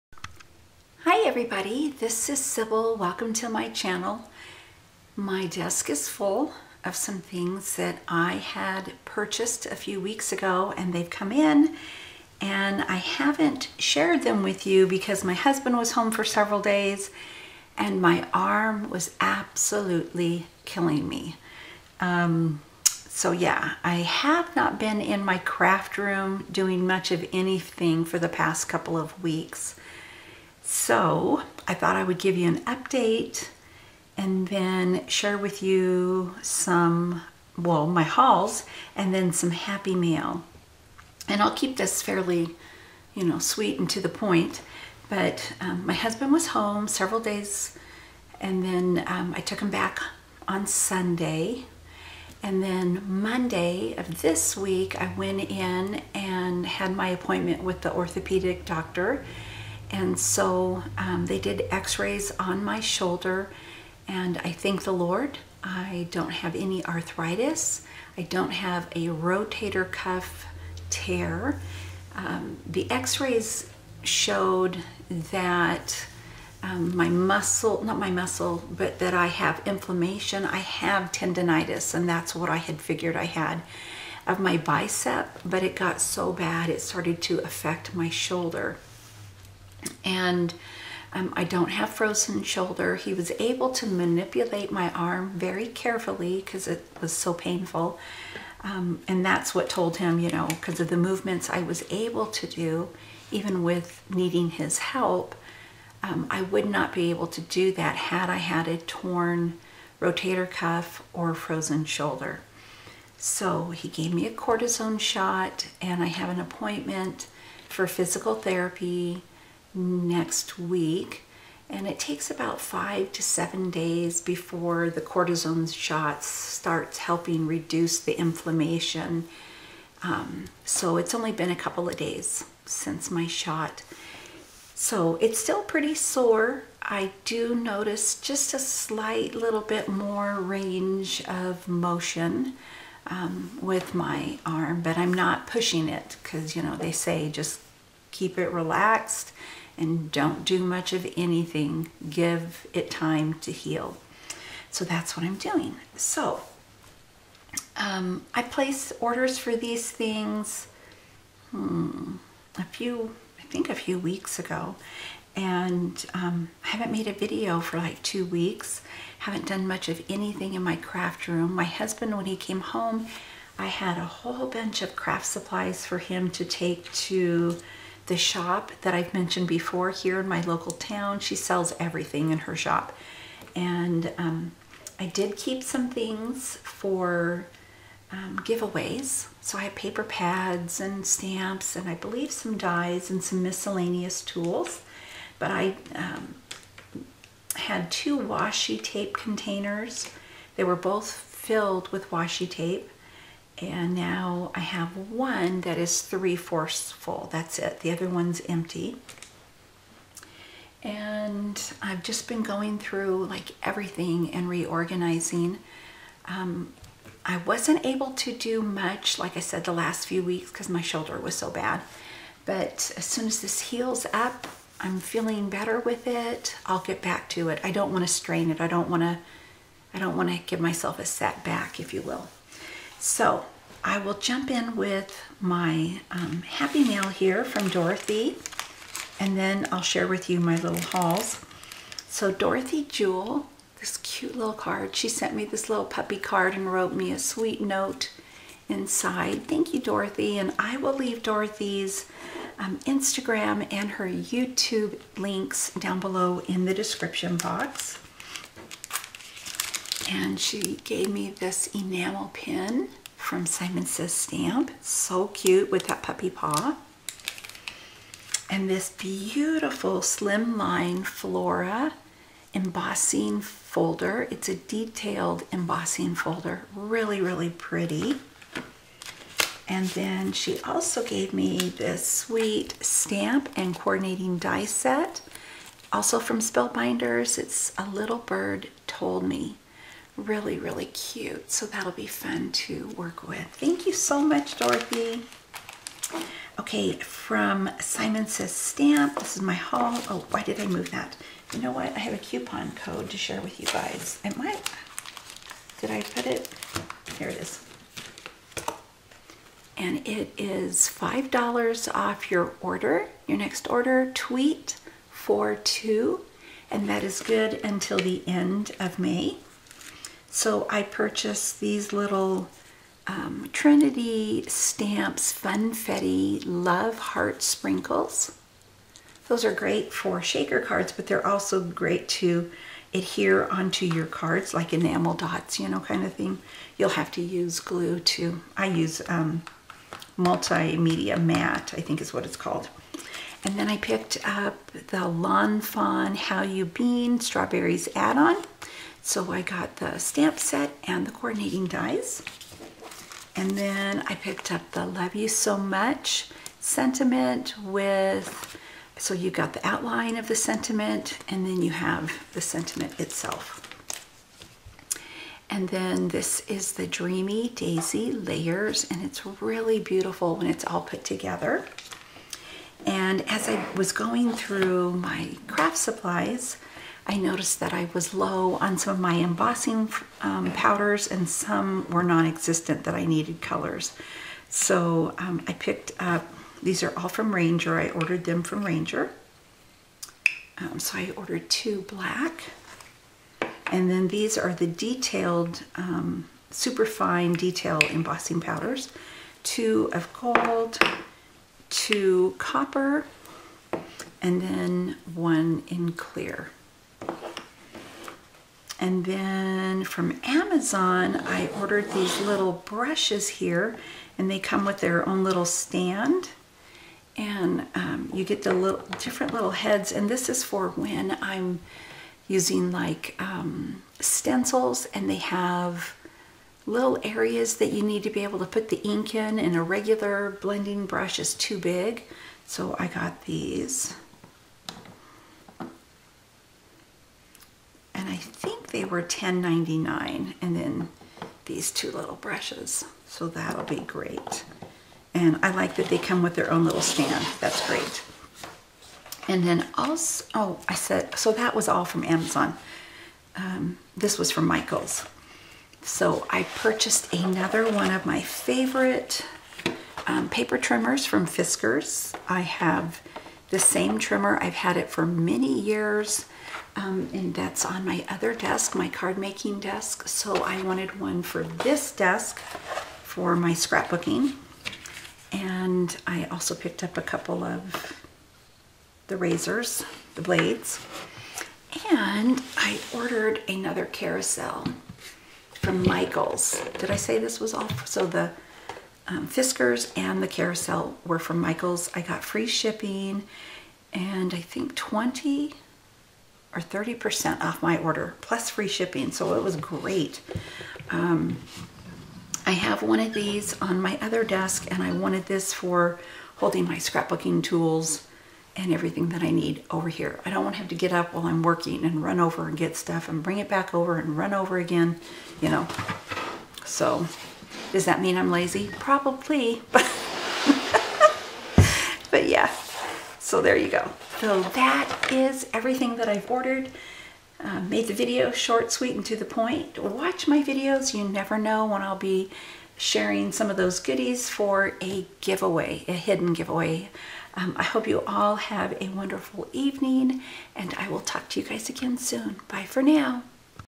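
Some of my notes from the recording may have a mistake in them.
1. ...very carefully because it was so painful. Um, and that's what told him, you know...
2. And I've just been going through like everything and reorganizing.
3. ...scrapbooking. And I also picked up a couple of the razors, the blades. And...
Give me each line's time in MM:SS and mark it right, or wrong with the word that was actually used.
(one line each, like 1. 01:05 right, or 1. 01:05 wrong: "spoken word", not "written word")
1. 01:35 right
2. 03:30 right
3. 07:53 right.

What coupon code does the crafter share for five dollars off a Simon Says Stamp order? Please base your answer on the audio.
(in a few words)
tweet 42.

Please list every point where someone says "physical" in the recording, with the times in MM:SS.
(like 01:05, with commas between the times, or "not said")
01:57.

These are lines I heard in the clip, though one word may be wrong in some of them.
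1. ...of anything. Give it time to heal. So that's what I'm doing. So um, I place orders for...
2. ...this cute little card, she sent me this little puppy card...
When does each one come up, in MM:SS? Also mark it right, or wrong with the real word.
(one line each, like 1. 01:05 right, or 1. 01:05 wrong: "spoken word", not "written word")
1. 02:30 right
2. 04:03 right.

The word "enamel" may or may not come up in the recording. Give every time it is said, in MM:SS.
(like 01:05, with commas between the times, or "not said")
04:21, 05:34.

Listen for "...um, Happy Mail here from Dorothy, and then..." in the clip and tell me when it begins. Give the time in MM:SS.
03:56.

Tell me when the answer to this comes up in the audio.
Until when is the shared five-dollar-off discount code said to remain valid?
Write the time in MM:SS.
05:17.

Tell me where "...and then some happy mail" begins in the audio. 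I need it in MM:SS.
00:38.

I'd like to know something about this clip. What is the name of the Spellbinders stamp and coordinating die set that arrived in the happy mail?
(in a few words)
A Little Bird Told Me.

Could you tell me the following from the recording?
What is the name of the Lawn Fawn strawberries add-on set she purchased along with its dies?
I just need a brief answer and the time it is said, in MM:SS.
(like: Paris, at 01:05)
How You Bean Strawberries, at 05:46.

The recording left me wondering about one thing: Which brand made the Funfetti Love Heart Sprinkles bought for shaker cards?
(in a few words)
Trinity Stamps.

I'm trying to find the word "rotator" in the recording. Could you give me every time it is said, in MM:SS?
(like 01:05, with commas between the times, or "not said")
01:09, 01:49.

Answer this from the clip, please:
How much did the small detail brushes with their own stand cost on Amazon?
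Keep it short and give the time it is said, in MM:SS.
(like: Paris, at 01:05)
$10.99, at 07:19.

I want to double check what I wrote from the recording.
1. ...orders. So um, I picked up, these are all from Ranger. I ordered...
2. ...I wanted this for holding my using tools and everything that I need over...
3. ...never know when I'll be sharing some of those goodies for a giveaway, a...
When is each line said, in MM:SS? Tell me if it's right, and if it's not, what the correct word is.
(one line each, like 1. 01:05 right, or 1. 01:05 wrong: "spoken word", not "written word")
1. 06:23 wrong: "colors", not "orders"
2. 08:24 wrong: "scrapbooking", not "using"
3. 08:51 right.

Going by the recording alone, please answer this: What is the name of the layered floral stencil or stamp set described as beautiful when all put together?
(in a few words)
Dreamy Daisy Layers.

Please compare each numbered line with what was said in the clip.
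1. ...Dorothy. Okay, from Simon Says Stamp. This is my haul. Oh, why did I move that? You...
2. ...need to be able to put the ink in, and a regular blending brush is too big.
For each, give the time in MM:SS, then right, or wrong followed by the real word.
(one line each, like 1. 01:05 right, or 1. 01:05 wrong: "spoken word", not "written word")
1. 04:54 right
2. 07:07 right.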